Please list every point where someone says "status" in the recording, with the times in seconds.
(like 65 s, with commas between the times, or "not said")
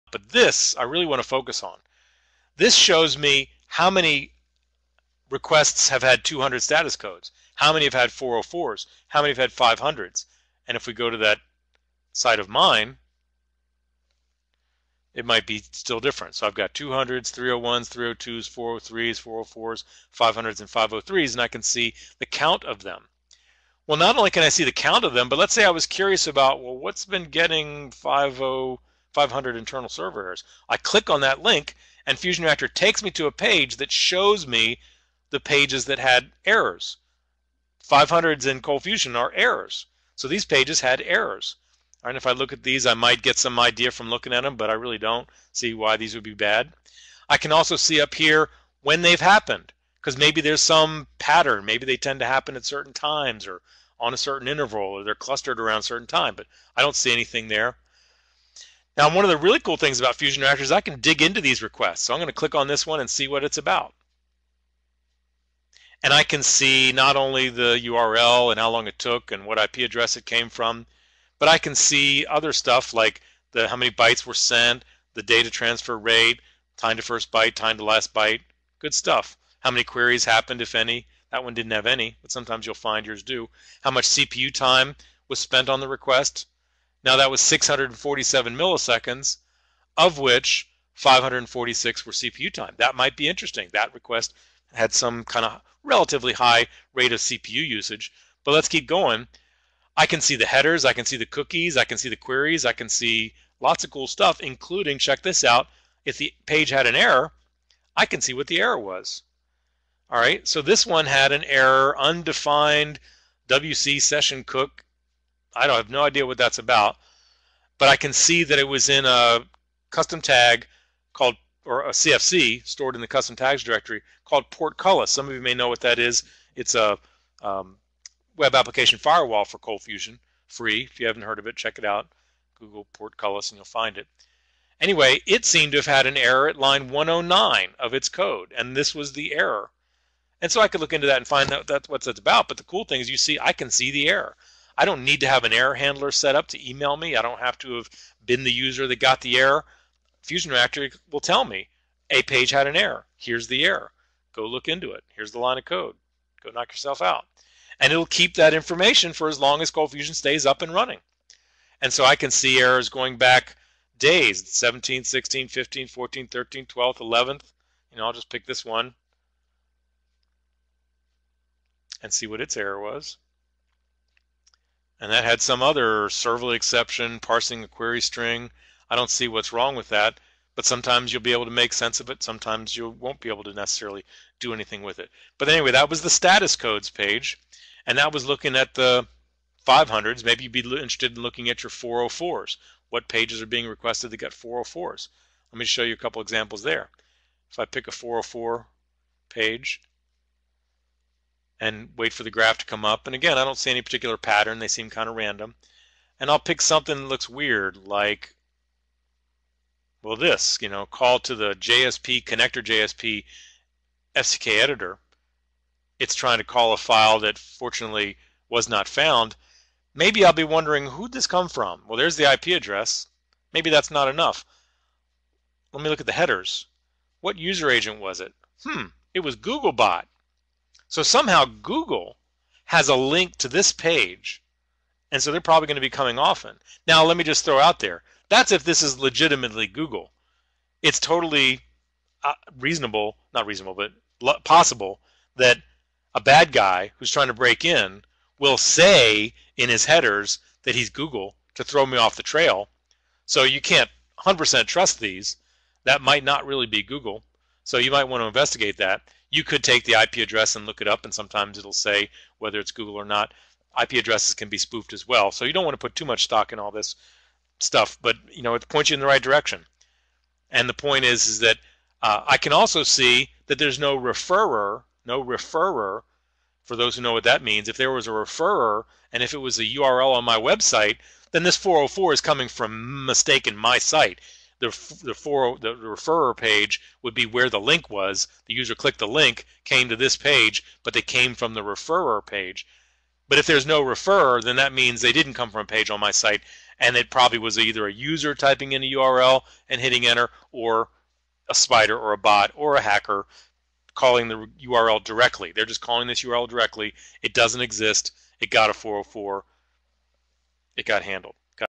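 6 s, 186 s.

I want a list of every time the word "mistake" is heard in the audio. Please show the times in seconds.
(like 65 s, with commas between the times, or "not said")
283 s.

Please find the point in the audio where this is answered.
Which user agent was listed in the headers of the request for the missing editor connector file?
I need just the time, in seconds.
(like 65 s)
229 s.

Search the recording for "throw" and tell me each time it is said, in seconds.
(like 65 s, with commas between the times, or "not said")
237 s, 251 s.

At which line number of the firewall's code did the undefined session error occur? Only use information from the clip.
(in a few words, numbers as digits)
109.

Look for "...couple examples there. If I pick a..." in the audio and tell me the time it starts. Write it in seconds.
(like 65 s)
195 s.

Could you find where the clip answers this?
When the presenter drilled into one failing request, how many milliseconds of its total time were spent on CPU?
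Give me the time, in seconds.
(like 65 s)
90 s.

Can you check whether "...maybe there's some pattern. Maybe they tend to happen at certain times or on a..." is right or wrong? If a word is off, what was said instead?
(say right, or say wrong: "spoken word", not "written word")
right.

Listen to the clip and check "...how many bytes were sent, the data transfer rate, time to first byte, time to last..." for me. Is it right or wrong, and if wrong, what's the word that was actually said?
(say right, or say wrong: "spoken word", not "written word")
right.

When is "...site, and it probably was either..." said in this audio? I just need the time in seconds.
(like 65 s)
296 s.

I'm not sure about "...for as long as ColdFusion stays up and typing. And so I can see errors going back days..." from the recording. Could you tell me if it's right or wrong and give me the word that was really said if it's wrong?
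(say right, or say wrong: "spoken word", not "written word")
wrong: "running", not "typing".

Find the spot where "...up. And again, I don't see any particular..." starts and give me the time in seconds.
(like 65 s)
202 s.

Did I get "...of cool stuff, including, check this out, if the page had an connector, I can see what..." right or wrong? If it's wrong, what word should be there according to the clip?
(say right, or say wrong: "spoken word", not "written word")
wrong: "error", not "connector".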